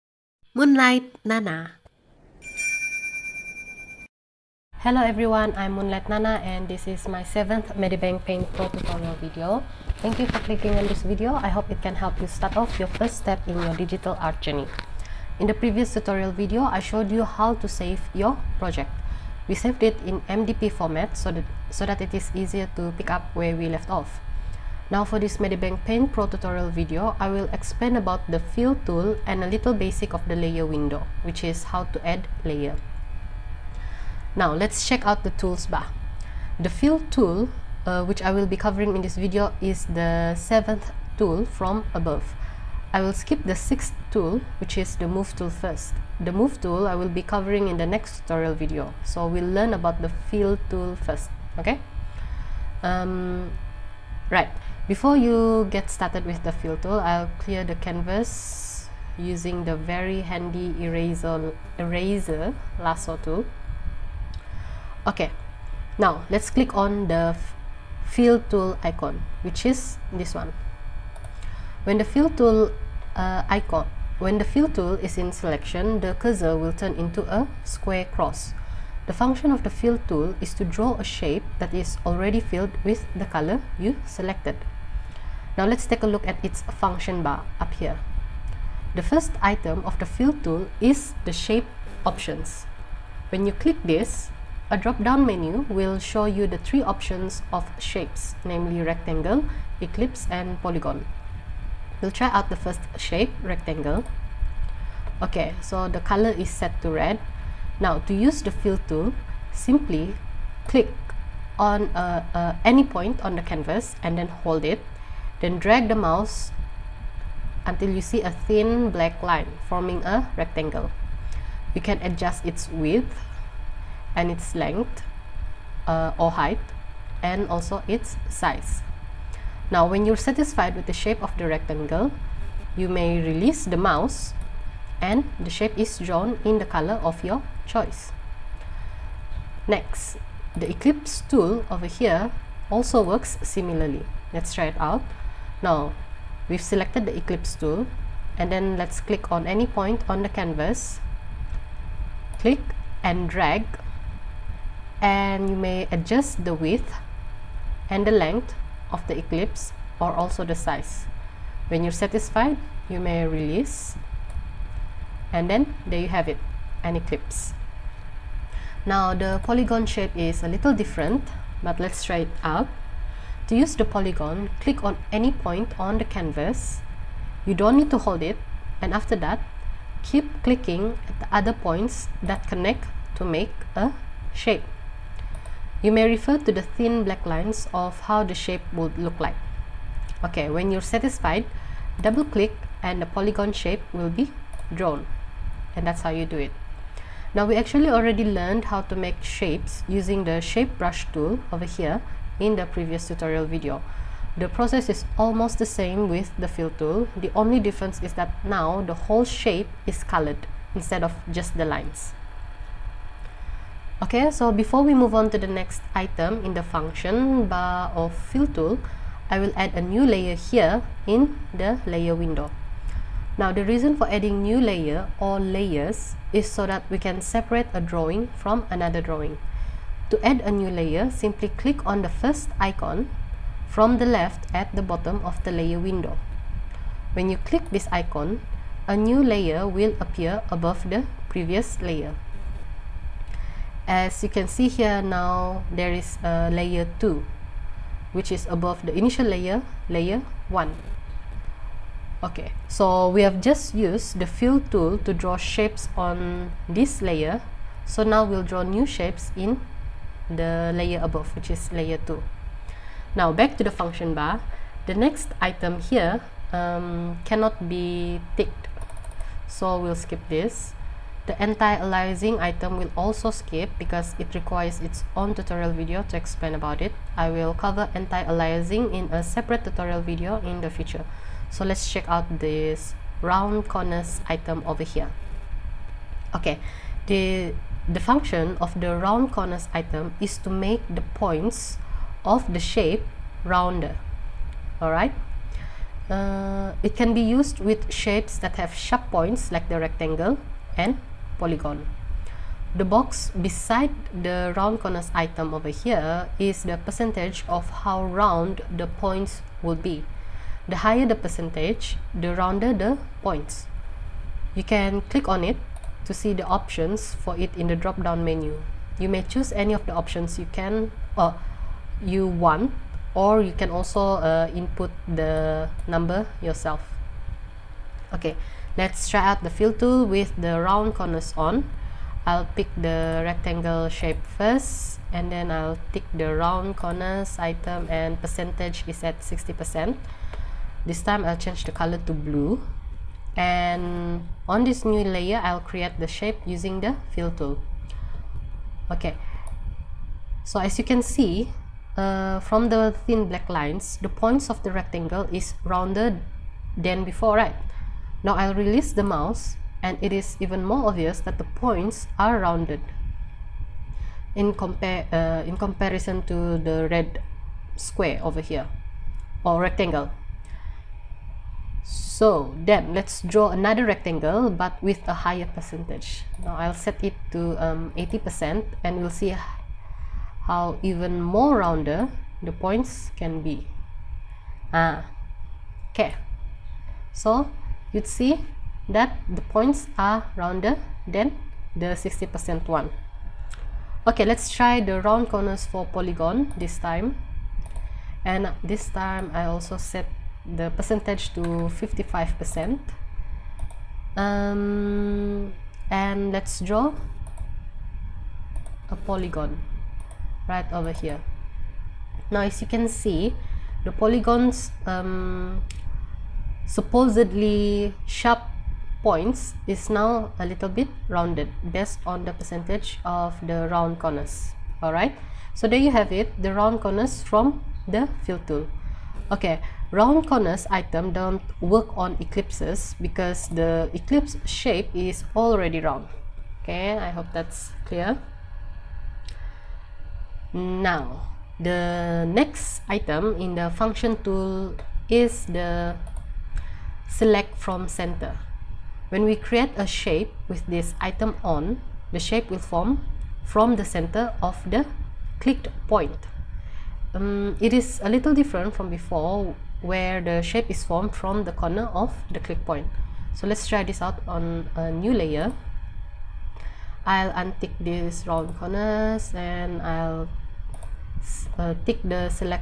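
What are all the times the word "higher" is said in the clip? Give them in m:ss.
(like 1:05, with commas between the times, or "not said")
5:10, 6:15.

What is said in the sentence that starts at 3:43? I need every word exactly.
Now the reason for adding new layer or layers is so that we can separate a drawing from another drawing.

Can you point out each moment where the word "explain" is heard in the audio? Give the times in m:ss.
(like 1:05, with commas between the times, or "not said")
0:27, 4:36.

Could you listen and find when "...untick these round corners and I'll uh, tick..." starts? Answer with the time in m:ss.
7:47.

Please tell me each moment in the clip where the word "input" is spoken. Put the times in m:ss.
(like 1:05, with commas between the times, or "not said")
5:24.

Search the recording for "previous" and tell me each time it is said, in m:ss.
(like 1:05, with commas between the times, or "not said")
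0:15, 3:22, 4:01.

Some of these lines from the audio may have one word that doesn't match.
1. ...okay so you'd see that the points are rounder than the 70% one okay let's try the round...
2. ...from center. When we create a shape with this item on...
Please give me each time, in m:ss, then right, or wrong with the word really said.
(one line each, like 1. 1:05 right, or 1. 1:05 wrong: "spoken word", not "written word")
1. 6:25 wrong: "60", not "70"
2. 7:27 right.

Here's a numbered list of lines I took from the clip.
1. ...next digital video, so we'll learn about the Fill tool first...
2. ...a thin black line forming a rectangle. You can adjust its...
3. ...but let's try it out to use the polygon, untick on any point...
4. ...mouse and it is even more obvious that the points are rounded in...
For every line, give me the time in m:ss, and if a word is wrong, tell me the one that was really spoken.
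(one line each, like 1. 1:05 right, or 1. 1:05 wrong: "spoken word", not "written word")
1. 0:47 wrong: "tutorial", not "digital"
2. 1:58 right
3. 2:51 wrong: "click", not "untick"
4. 5:59 right.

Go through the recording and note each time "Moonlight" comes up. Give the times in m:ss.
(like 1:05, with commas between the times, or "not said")
0:00, 0:05.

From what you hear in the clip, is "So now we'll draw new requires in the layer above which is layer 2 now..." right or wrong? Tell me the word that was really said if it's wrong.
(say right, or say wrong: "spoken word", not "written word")
wrong: "shapes", not "requires".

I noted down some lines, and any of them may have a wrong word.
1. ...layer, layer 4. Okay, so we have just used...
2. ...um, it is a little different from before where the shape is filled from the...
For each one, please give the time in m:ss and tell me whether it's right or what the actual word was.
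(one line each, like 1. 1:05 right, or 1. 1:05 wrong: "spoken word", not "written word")
1. 4:09 wrong: "1", not "4"
2. 7:37 wrong: "formed", not "filled".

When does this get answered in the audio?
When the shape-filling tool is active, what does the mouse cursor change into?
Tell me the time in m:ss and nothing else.
1:17.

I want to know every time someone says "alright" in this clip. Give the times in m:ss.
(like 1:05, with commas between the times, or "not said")
4:54, 7:04.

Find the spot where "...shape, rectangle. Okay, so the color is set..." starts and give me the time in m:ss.
1:42.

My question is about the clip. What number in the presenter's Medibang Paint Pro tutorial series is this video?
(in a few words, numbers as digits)
7th.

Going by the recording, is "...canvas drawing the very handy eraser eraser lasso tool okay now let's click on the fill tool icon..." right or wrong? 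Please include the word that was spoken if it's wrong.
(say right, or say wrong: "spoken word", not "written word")
wrong: "using", not "drawing".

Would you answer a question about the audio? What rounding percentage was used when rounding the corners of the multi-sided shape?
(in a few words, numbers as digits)
55%.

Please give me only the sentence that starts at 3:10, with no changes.
Okay, when you're satisfied, double click and the polygon shape will be drawn.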